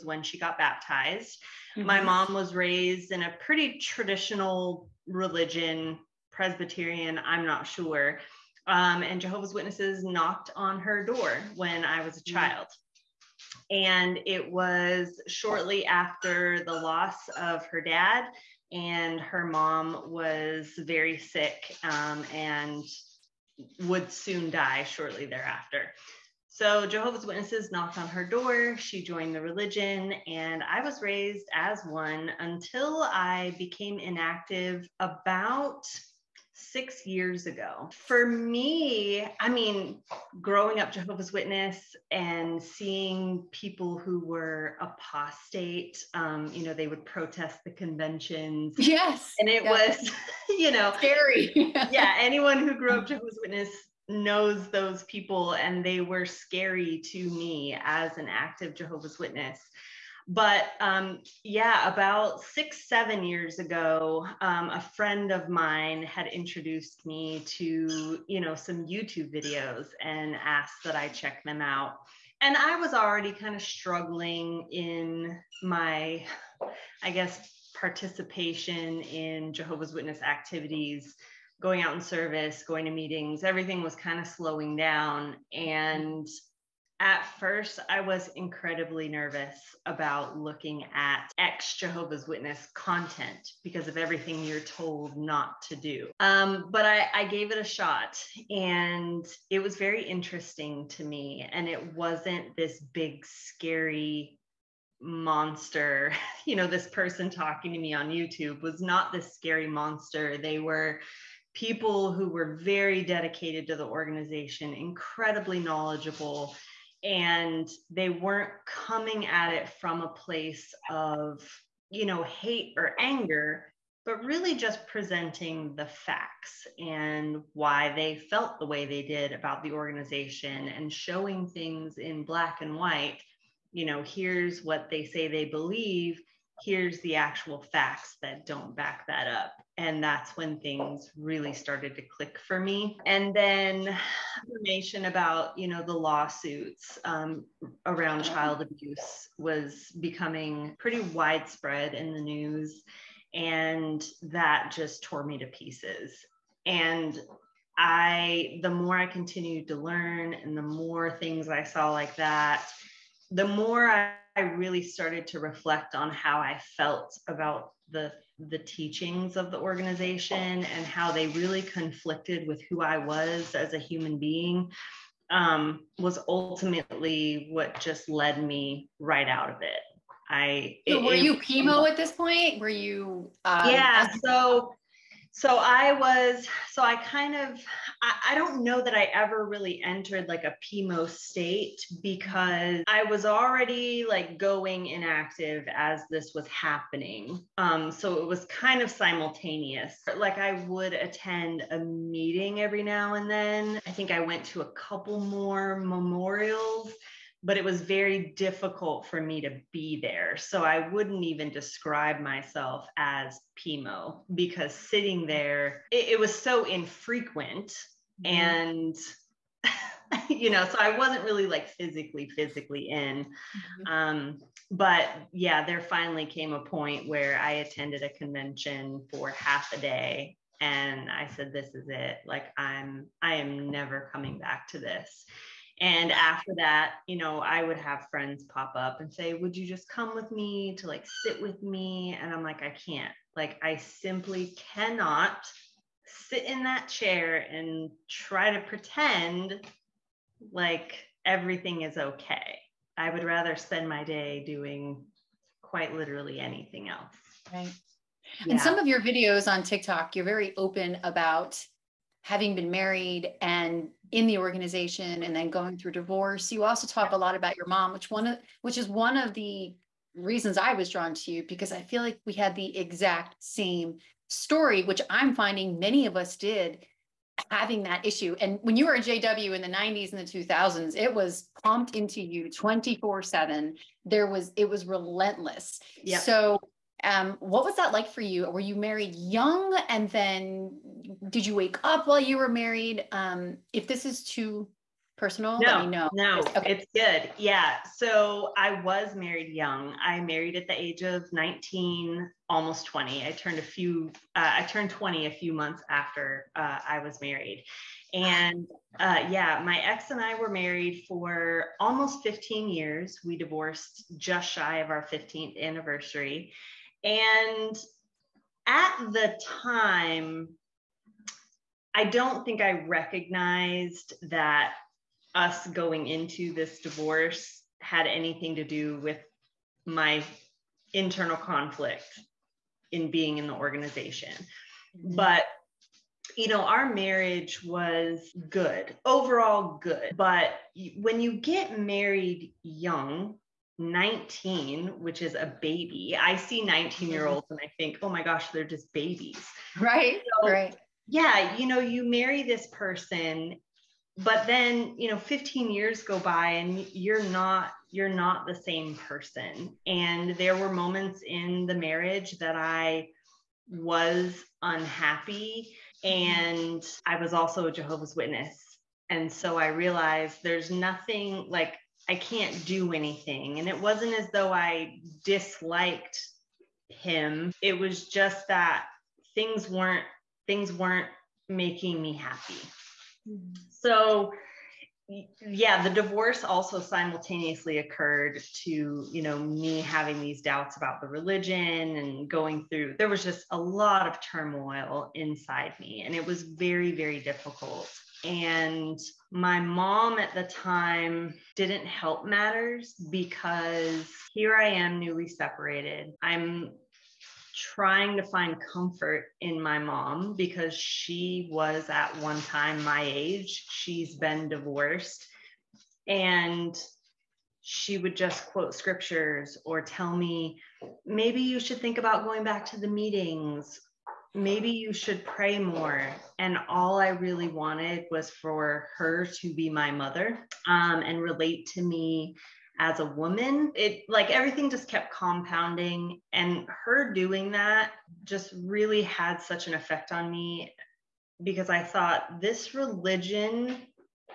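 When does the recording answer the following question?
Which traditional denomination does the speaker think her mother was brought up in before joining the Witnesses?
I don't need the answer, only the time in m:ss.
0:06.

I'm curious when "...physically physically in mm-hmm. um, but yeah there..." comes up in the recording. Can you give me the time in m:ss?
3:41.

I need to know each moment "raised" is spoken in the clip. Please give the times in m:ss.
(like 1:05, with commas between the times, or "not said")
0:02, 0:31.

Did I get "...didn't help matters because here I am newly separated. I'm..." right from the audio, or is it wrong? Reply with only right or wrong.
right.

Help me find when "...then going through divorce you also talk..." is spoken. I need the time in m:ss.
4:25.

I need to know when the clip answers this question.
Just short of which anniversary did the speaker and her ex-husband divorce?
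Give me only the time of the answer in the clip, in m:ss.
5:15.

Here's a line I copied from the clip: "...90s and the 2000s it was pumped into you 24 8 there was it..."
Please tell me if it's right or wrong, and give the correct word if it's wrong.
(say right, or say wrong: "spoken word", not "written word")
wrong: "7", not "8".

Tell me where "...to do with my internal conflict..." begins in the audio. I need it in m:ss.
5:28.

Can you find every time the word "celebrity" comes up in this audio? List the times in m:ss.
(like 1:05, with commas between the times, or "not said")
not said.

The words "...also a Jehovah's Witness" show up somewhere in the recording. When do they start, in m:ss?
6:07.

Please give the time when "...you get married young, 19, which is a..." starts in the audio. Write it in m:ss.
5:41.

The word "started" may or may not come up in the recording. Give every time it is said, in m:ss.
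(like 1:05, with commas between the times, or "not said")
2:21, 2:44.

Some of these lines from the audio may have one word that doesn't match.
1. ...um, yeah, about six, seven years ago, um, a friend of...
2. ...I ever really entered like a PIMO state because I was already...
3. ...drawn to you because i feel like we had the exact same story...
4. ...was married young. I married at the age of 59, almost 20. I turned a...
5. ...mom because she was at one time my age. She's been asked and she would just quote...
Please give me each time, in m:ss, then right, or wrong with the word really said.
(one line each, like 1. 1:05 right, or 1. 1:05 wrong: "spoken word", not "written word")
1. 1:00 right
2. 3:08 right
3. 4:30 right
4. 4:58 wrong: "19", not "59"
5. 6:49 wrong: "divorced", not "asked".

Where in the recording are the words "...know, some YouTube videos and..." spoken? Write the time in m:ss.
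1:08.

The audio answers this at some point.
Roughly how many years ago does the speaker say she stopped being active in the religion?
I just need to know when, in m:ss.
0:36.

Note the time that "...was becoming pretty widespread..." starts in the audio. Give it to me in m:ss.
2:29.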